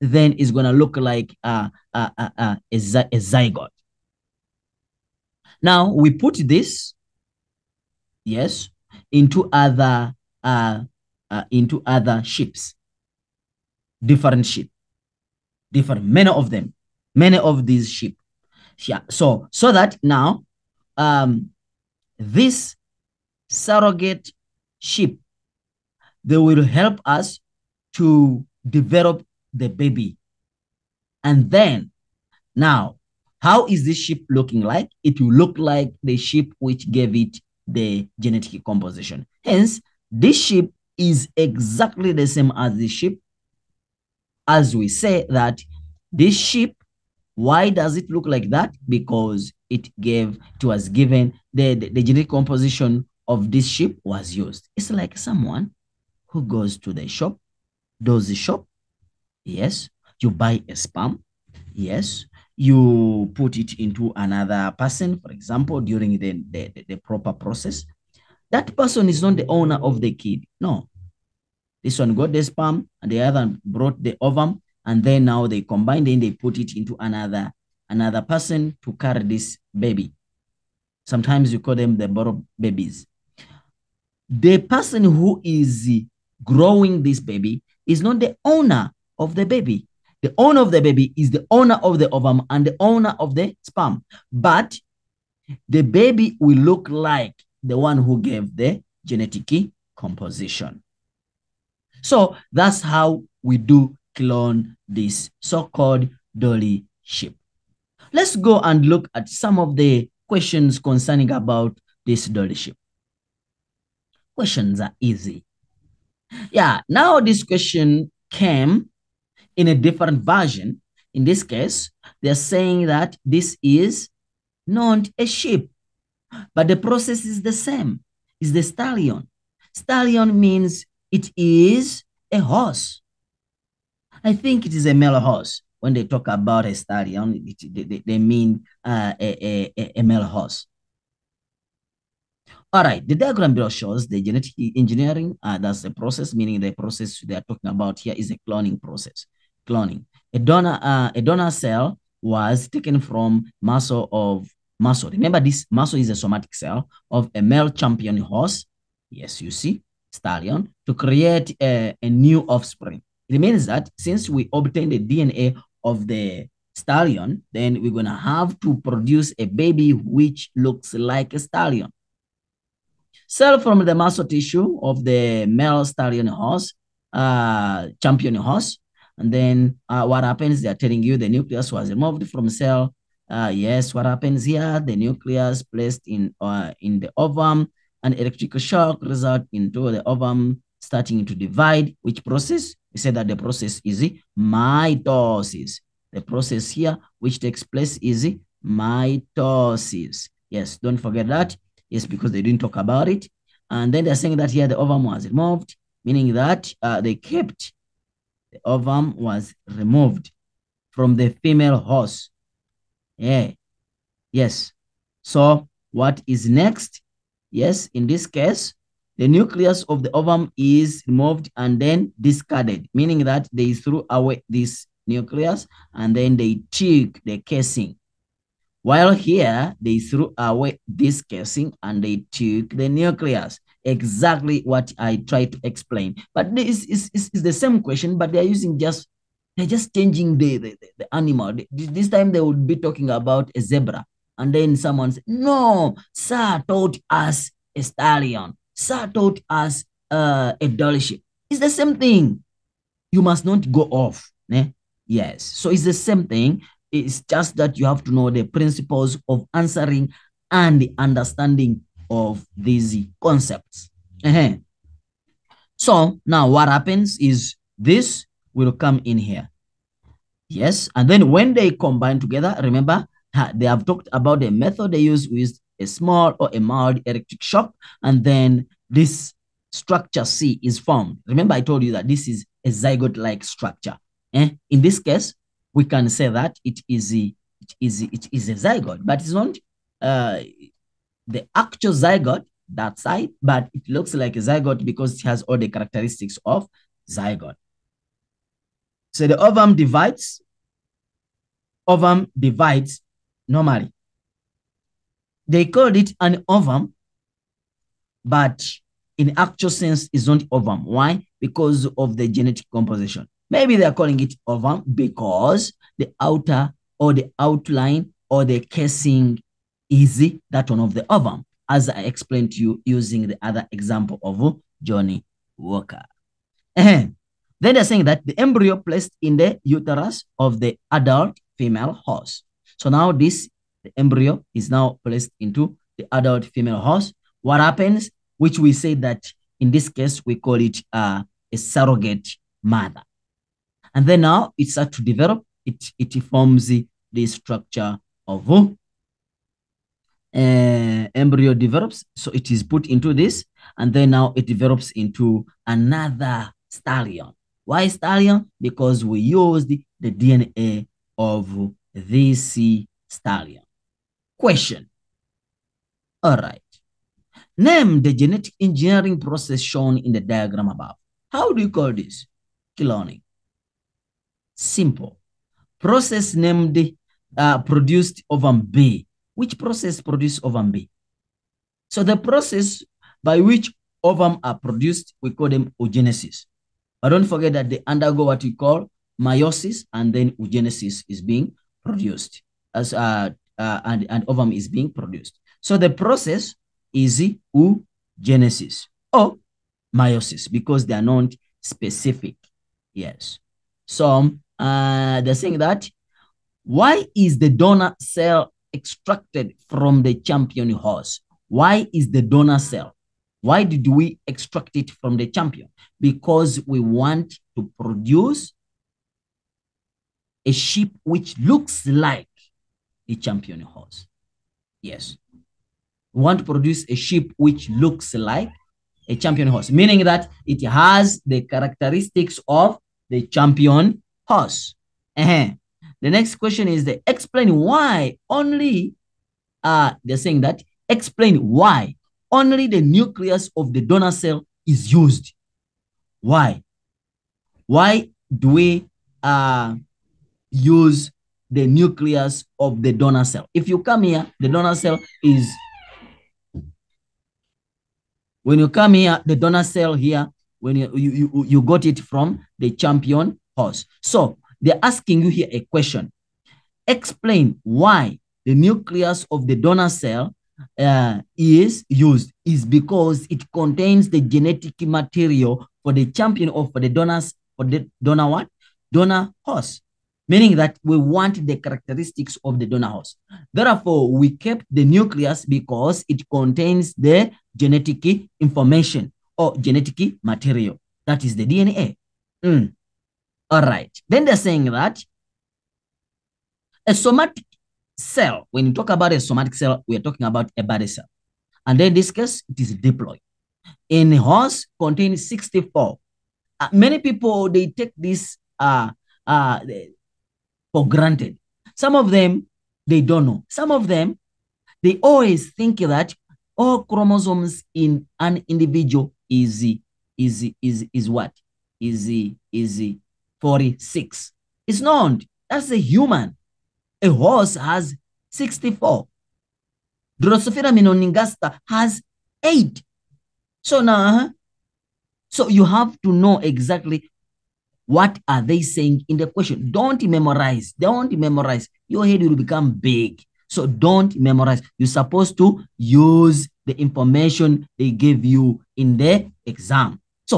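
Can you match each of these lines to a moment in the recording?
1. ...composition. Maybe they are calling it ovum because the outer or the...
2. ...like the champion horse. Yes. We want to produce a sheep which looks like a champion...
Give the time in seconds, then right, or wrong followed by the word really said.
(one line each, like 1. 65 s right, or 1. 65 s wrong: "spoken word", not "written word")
1. 312 s right
2. 421 s right.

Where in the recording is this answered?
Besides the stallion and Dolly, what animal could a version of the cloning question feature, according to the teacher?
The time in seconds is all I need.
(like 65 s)
243 s.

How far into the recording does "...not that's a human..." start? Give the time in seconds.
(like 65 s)
524 s.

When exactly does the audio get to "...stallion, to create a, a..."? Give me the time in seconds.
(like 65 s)
160 s.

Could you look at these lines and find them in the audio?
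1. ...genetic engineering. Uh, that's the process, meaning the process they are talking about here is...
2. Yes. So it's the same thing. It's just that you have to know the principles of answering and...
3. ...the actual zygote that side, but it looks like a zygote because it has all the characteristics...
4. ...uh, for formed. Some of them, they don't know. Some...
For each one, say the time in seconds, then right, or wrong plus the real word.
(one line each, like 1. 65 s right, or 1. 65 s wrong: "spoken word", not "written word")
1. 144 s right
2. 255 s right
3. 291 s right
4. 509 s wrong: "granted", not "formed".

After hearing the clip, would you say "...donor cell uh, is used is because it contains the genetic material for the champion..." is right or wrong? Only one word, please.
right.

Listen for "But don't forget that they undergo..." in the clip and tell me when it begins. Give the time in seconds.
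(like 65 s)
387 s.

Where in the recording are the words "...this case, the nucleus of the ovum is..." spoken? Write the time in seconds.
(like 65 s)
218 s.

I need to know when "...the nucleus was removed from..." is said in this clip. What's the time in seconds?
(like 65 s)
181 s.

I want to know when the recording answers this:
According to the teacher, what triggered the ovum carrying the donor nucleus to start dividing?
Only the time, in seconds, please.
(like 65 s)
188 s.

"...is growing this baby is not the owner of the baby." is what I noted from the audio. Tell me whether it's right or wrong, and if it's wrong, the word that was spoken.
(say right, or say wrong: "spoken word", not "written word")
right.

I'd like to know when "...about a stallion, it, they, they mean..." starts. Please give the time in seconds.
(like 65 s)
136 s.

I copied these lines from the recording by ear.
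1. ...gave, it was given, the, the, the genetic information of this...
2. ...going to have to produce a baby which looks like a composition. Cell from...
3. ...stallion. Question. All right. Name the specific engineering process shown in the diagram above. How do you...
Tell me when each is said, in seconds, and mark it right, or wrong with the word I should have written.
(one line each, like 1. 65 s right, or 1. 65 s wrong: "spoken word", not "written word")
1. 49 s wrong: "composition", not "information"
2. 167 s wrong: "stallion", not "composition"
3. 363 s wrong: "genetic", not "specific".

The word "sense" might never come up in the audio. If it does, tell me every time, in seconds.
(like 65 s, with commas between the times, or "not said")
309 s.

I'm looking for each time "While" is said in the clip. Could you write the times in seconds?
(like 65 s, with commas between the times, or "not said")
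228 s.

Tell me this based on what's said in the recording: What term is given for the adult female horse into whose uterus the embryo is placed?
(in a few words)
Surrogate mother.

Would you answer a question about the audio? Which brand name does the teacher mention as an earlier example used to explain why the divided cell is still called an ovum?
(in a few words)
Johnnie Walker.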